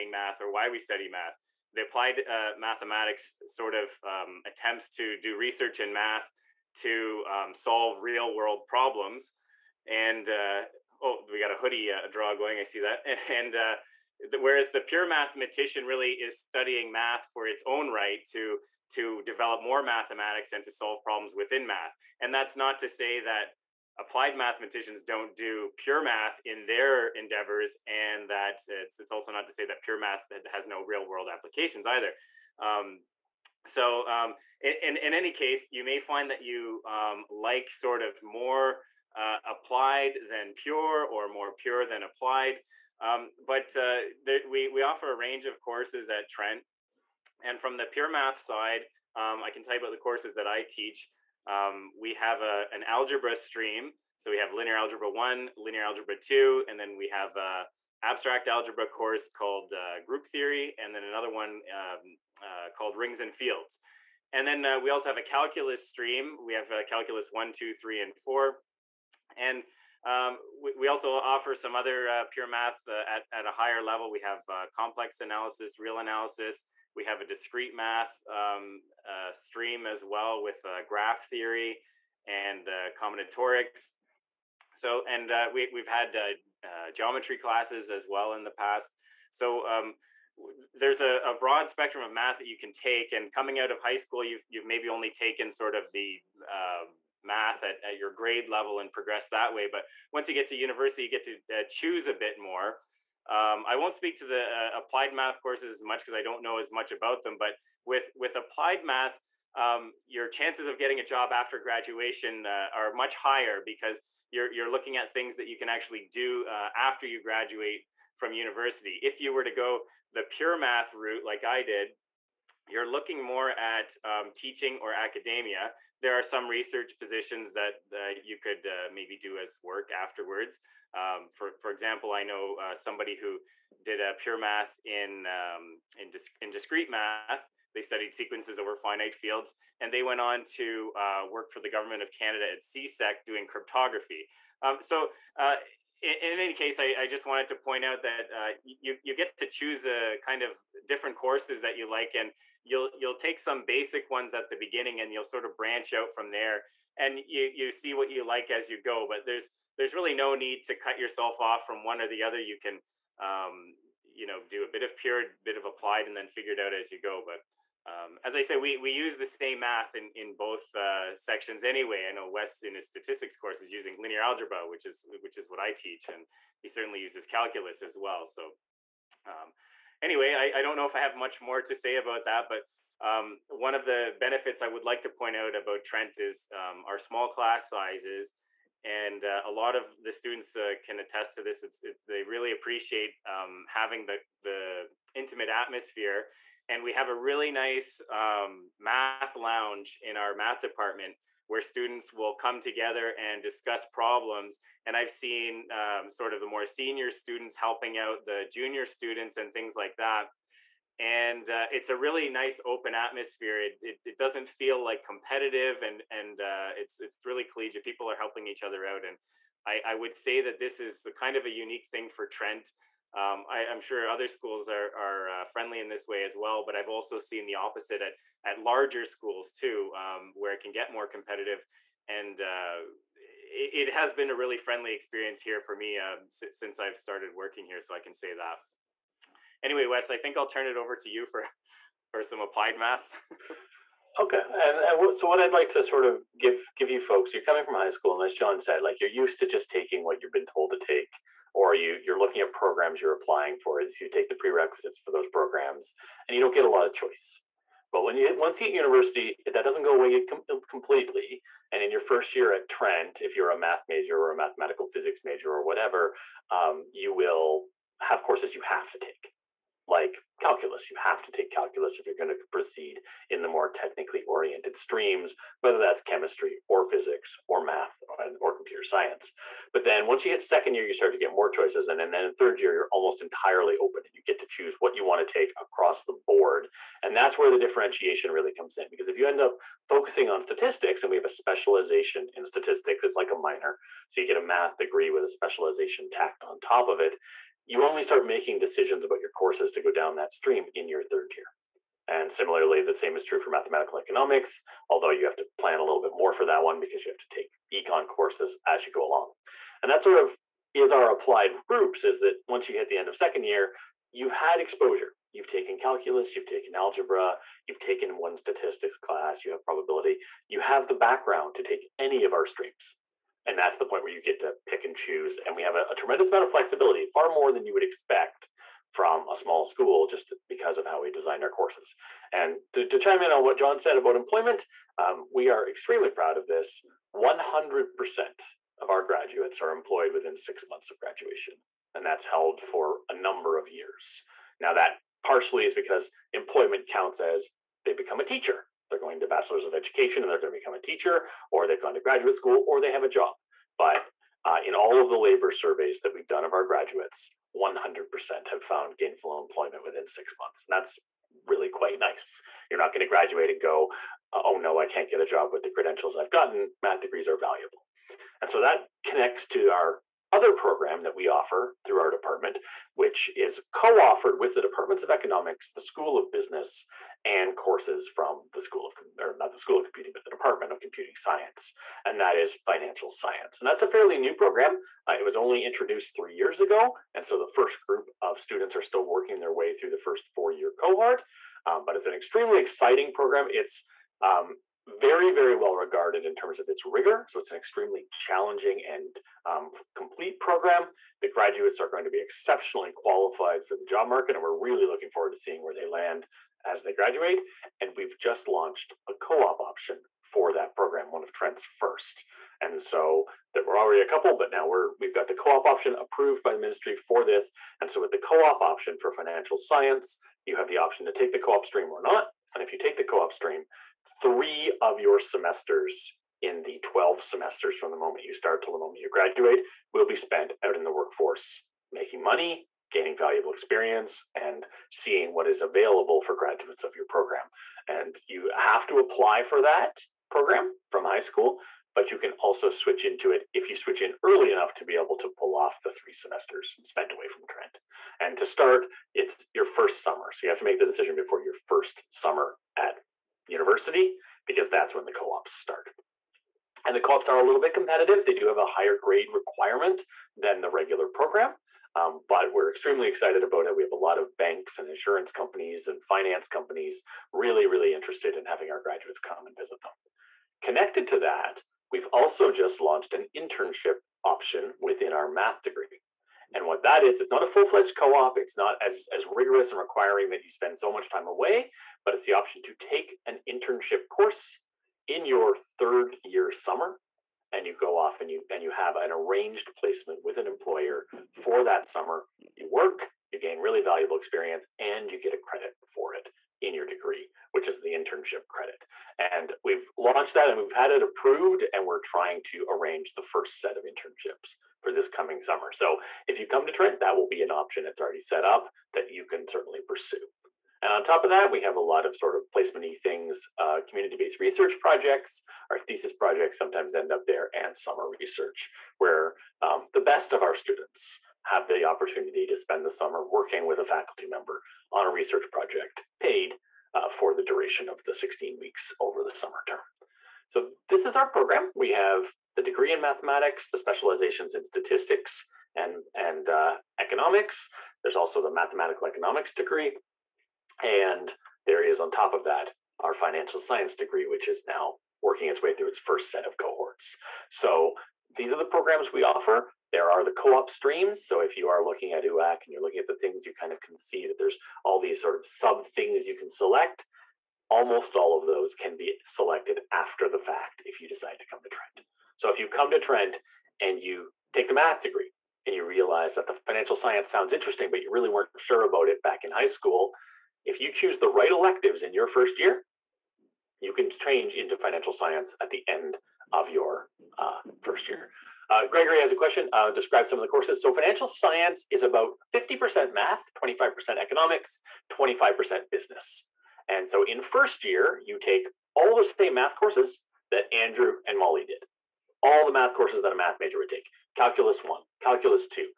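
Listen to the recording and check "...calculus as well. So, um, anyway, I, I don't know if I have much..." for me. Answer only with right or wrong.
right.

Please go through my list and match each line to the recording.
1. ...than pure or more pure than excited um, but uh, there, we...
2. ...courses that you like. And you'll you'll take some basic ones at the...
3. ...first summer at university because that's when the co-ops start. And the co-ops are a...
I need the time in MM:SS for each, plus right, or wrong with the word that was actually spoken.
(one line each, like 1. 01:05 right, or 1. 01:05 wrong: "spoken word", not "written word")
1. 00:40 wrong: "applied", not "excited"
2. 02:31 right
3. 07:31 right.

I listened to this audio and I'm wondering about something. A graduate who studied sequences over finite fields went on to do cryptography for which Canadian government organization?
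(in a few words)
CSEC.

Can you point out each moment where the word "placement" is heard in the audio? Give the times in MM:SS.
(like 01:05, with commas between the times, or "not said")
08:09, 08:32.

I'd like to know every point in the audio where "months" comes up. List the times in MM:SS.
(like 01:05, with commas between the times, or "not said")
05:40, 06:00.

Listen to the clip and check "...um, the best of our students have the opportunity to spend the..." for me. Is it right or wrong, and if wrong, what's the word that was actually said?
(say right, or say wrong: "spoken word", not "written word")
right.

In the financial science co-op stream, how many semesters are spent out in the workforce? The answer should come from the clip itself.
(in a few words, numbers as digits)
3.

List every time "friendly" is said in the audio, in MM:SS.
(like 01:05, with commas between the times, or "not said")
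03:45, 03:54.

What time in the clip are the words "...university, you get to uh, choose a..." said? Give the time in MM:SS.
01:40.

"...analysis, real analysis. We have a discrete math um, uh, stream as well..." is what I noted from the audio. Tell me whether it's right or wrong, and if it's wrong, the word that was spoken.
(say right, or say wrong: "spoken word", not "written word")
right.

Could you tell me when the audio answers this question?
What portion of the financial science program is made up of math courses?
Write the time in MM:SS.
09:42.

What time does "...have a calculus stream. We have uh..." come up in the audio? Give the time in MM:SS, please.
01:05.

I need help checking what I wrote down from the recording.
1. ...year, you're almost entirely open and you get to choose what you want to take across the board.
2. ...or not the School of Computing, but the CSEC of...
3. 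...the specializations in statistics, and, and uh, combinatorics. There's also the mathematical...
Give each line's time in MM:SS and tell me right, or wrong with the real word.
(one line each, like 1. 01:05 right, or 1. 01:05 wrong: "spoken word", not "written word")
1. 04:42 right
2. 06:19 wrong: "Department", not "CSEC"
3. 08:53 wrong: "economics", not "combinatorics".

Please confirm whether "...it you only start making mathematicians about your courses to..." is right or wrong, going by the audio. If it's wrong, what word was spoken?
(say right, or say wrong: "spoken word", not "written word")
wrong: "decisions", not "mathematicians".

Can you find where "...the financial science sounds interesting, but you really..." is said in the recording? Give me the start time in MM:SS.
09:26.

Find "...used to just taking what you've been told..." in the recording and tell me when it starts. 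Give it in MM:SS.
04:09.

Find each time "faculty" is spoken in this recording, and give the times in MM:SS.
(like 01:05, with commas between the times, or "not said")
08:43.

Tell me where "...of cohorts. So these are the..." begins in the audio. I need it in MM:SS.
09:06.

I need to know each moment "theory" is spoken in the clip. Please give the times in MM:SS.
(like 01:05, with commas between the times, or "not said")
01:00, 01:21.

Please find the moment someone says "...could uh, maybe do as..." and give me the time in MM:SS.
02:08.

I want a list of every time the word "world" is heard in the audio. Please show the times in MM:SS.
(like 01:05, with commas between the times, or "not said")
00:08, 00:31.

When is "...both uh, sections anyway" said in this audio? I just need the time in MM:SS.
02:50.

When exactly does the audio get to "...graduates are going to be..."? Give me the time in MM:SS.
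06:41.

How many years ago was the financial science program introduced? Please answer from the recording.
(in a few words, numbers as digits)
3.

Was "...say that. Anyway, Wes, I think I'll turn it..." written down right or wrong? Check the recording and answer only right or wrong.
right.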